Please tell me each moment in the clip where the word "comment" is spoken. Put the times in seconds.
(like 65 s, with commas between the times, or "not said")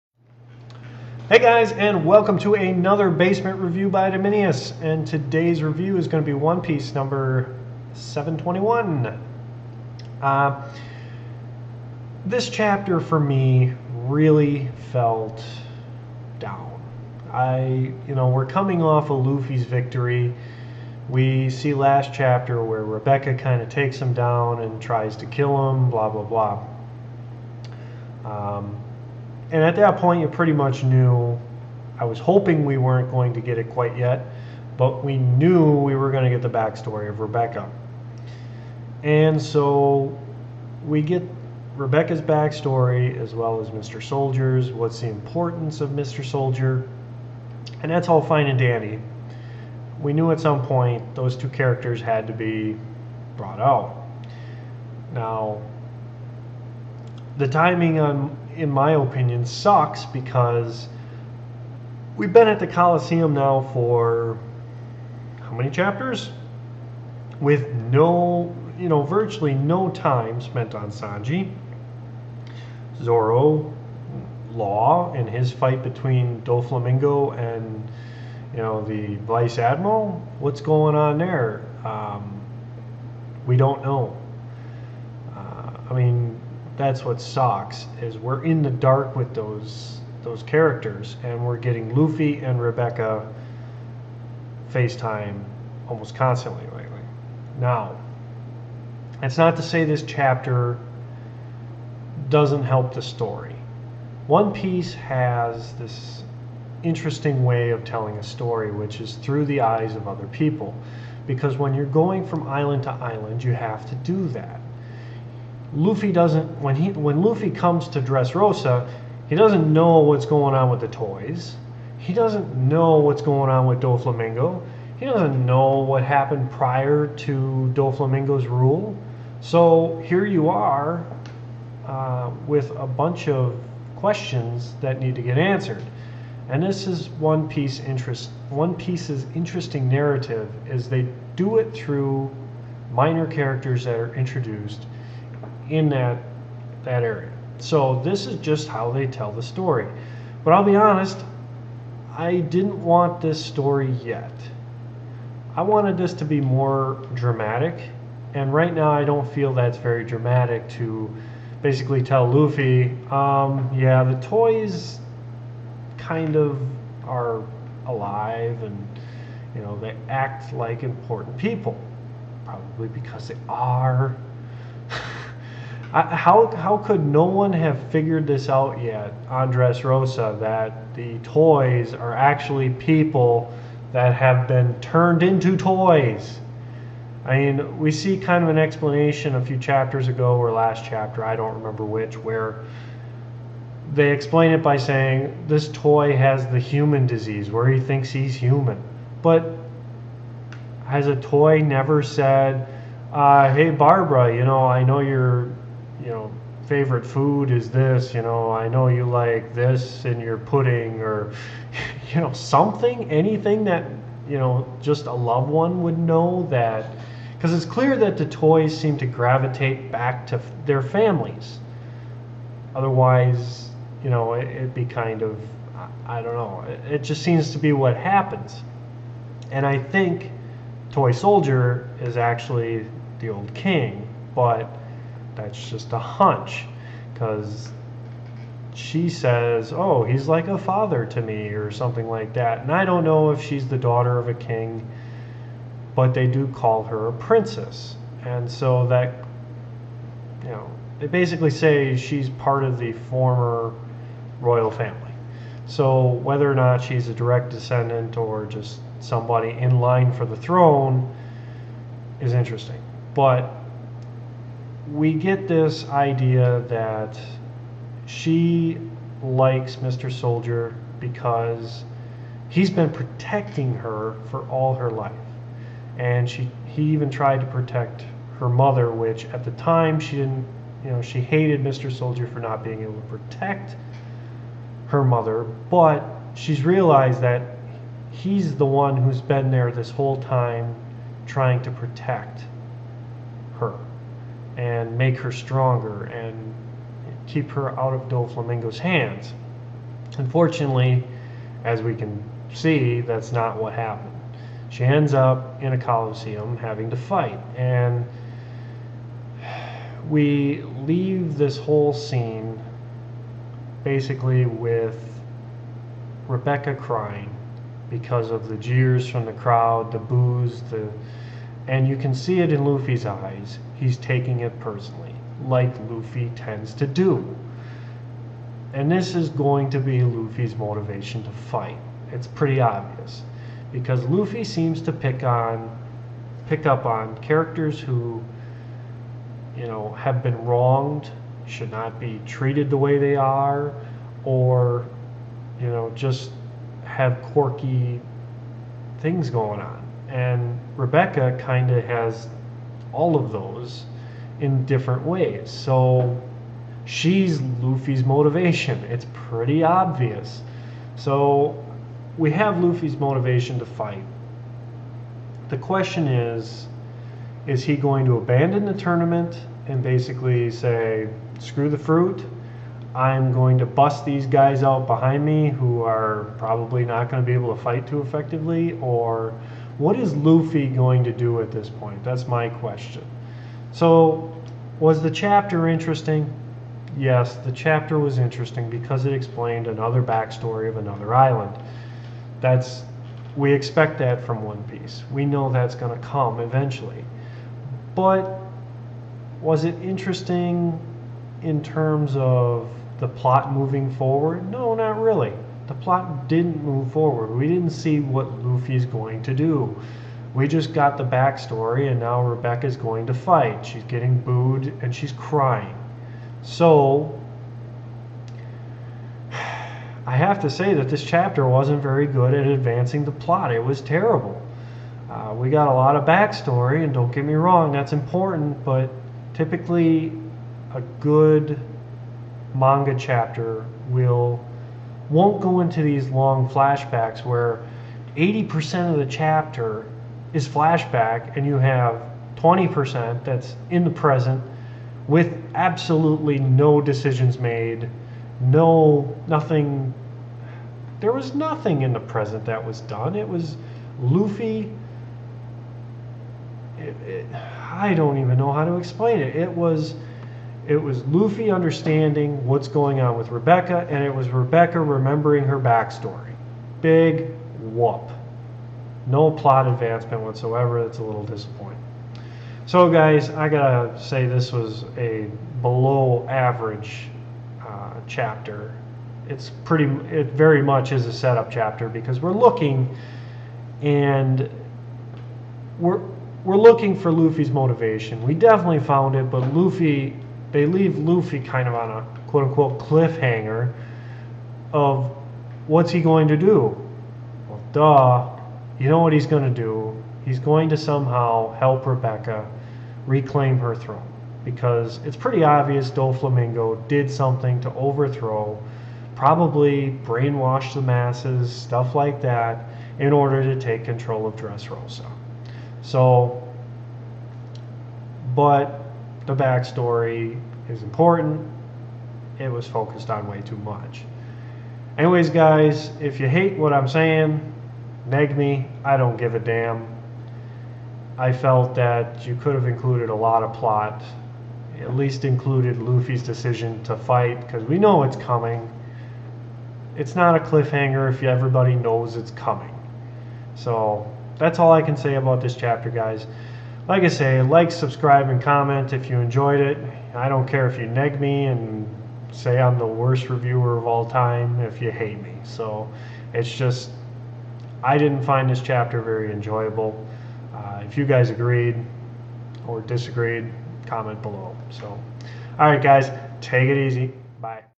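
548 s, 563 s.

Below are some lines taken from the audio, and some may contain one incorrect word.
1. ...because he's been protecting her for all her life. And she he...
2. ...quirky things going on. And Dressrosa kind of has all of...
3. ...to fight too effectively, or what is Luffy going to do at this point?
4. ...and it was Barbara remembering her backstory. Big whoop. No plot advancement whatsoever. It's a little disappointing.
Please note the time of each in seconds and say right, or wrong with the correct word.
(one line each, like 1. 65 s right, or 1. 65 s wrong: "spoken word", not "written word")
1. 270 s right
2. 347 s wrong: "Rebecca", not "Dressrosa"
3. 377 s right
4. 463 s wrong: "Rebecca", not "Barbara".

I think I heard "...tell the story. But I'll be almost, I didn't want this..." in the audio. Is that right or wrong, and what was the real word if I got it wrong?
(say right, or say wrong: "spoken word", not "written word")
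wrong: "honest", not "almost".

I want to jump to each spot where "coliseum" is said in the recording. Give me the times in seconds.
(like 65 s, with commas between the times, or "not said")
62 s, 305 s.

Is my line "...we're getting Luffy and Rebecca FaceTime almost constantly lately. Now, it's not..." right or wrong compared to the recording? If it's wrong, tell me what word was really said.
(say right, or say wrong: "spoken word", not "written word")
right.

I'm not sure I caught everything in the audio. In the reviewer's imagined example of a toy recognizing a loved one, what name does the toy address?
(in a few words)
Barbara.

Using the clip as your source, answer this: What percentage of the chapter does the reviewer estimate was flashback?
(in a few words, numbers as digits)
80%.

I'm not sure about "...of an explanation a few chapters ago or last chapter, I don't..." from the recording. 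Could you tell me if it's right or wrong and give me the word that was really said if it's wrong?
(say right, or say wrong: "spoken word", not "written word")
right.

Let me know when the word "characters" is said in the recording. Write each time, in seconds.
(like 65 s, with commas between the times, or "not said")
51 s, 90 s, 143 s, 337 s.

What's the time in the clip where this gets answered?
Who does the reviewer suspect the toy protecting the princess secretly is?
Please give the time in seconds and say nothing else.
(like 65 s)
233 s.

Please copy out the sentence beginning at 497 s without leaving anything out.
Well, duh, you know what he's going to do.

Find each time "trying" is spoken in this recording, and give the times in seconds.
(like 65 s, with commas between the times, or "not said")
291 s.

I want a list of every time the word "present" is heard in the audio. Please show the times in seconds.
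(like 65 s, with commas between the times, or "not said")
443 s, 451 s.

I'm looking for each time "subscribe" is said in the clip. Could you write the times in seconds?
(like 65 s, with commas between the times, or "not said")
547 s.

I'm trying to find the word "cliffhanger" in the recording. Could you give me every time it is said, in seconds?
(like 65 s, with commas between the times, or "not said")
492 s, 540 s.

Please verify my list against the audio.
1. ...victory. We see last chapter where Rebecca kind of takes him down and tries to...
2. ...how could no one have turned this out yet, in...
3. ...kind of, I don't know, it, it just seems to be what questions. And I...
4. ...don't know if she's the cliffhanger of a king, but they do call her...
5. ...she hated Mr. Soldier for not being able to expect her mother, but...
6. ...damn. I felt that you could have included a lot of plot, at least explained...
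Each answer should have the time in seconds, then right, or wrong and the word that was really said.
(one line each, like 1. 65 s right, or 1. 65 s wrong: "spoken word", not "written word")
1. 19 s right
2. 176 s wrong: "figured", not "turned"
3. 224 s wrong: "happens", not "questions"
4. 242 s wrong: "daughter", not "cliffhanger"
5. 281 s wrong: "protect", not "expect"
6. 529 s wrong: "included", not "explained".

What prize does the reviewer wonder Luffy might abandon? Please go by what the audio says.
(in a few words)
the fruit.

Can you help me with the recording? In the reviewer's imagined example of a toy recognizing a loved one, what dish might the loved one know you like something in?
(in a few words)
pudding.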